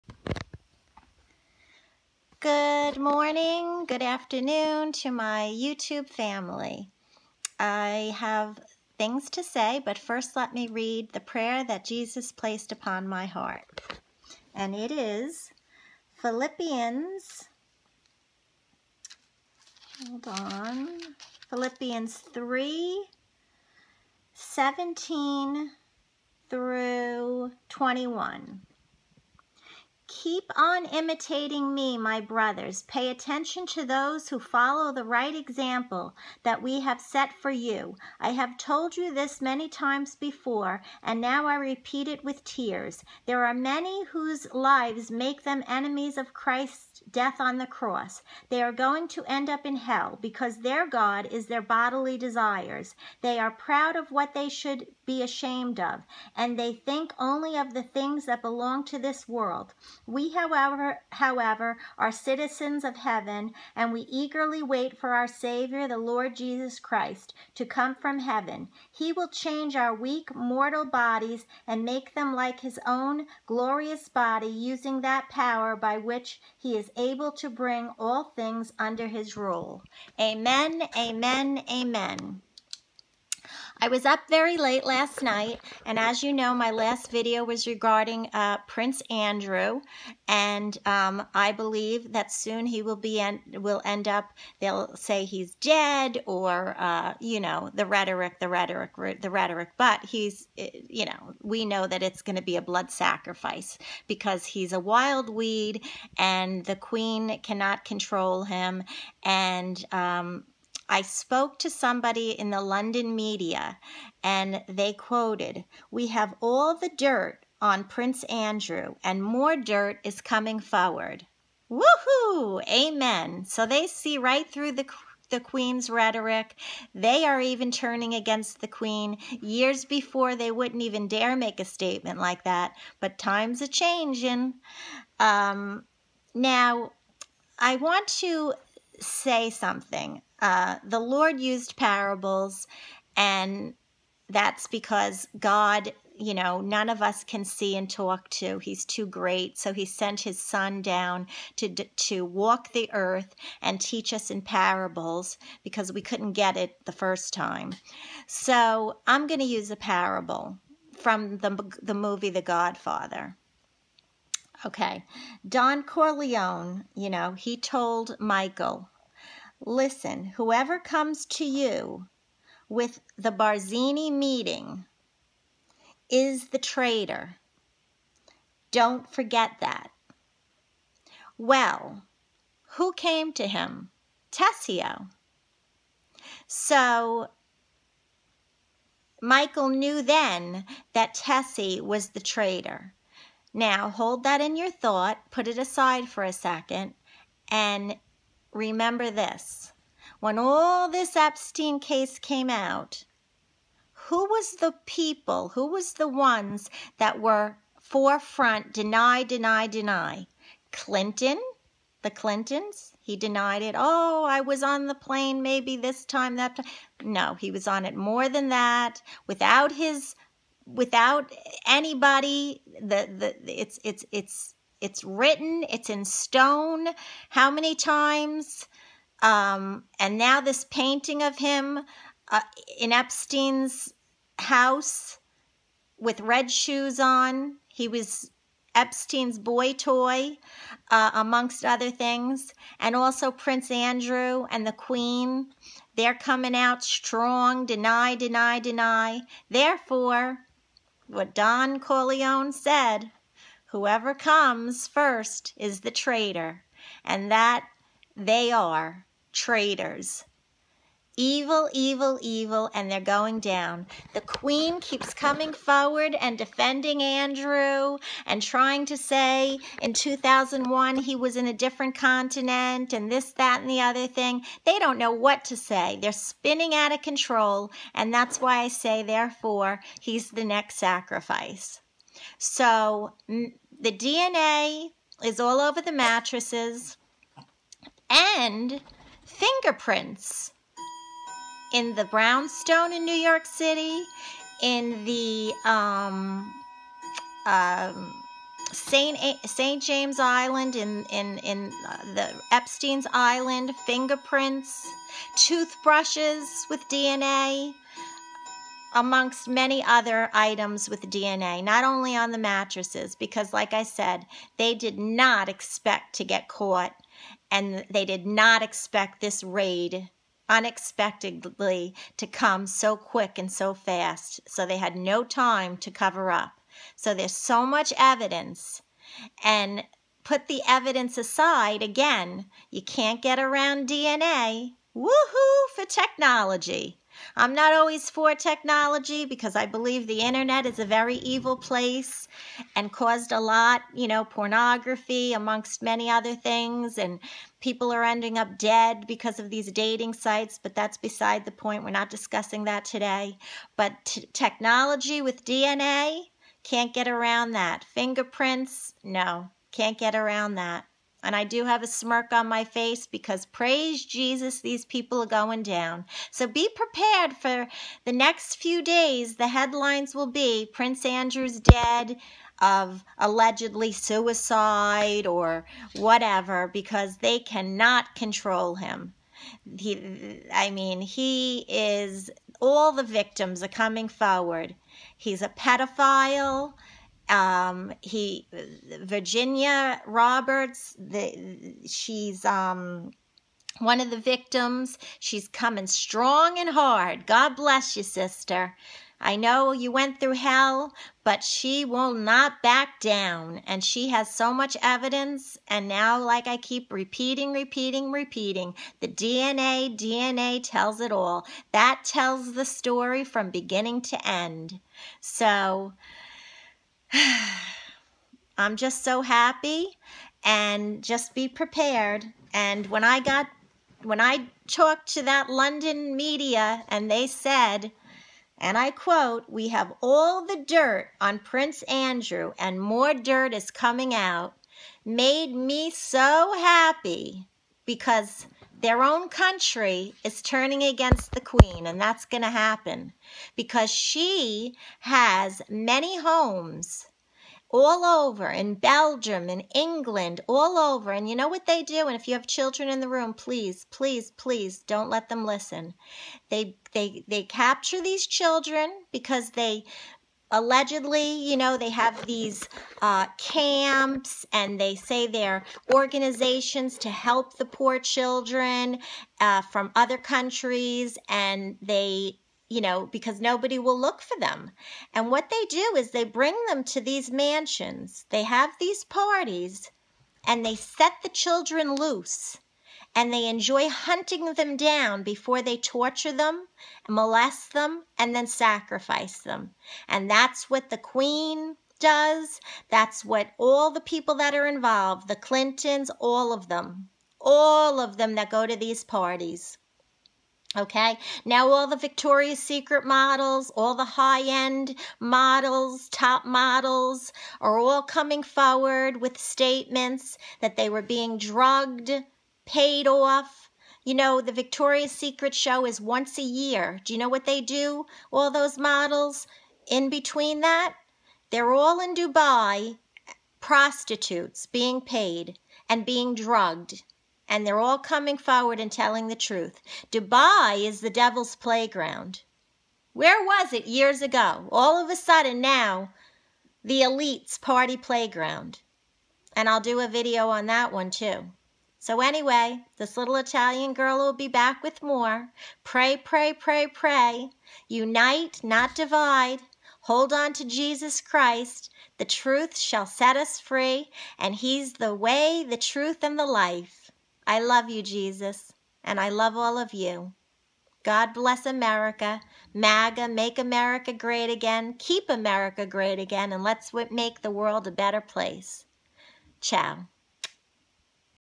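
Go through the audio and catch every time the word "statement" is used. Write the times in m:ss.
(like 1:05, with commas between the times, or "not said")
2:11, 8:29.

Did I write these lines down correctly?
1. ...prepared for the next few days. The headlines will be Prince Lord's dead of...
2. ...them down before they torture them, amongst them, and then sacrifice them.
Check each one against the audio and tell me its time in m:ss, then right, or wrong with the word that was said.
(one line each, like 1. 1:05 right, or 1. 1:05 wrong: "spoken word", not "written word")
1. 6:06 wrong: "Andrew", not "Lord"
2. 8:04 wrong: "molest", not "amongst".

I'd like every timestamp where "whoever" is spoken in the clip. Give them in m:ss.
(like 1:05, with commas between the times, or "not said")
2:50, 4:13.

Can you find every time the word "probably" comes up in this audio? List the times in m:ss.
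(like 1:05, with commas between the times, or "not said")
not said.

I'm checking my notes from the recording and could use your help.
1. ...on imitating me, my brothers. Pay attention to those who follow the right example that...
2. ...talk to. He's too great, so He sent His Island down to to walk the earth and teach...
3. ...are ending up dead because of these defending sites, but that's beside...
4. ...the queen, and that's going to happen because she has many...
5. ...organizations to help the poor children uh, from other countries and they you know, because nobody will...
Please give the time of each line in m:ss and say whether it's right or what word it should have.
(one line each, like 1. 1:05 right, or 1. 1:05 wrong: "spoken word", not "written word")
1. 0:30 right
2. 2:27 wrong: "Son", not "Island"
3. 5:47 wrong: "dating", not "defending"
4. 7:21 right
5. 7:45 right.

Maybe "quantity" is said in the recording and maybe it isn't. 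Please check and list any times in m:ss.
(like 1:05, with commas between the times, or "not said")
not said.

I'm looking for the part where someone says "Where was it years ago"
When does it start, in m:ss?
8:53.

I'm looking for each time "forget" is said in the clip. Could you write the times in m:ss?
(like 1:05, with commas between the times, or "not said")
2:59.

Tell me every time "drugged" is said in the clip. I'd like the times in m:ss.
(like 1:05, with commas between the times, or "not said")
8:31, 8:46.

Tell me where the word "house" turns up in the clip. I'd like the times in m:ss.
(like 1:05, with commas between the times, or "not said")
3:54.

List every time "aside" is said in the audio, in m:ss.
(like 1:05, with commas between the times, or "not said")
3:15, 5:31.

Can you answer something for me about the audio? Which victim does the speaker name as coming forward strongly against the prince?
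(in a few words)
Virginia Roberts.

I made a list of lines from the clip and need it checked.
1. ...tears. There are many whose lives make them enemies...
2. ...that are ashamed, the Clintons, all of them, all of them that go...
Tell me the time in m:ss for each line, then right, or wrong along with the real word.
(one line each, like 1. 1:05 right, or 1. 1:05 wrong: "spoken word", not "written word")
1. 0:42 right
2. 8:14 wrong: "involved", not "ashamed".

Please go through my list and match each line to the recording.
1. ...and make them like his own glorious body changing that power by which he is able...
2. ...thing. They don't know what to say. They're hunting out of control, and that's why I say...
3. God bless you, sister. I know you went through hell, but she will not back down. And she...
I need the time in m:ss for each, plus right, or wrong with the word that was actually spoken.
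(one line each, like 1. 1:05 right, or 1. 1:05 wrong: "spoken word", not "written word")
1. 1:11 wrong: "using", not "changing"
2. 4:34 wrong: "spinning", not "hunting"
3. 6:37 right.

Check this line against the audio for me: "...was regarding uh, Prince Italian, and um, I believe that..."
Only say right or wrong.
wrong.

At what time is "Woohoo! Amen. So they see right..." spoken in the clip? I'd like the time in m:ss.
2:01.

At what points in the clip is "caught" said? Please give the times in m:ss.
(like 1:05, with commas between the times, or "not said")
5:16.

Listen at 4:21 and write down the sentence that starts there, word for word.
Evil, evil, evil, and they're going down.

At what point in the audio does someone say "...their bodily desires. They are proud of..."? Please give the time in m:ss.
0:51.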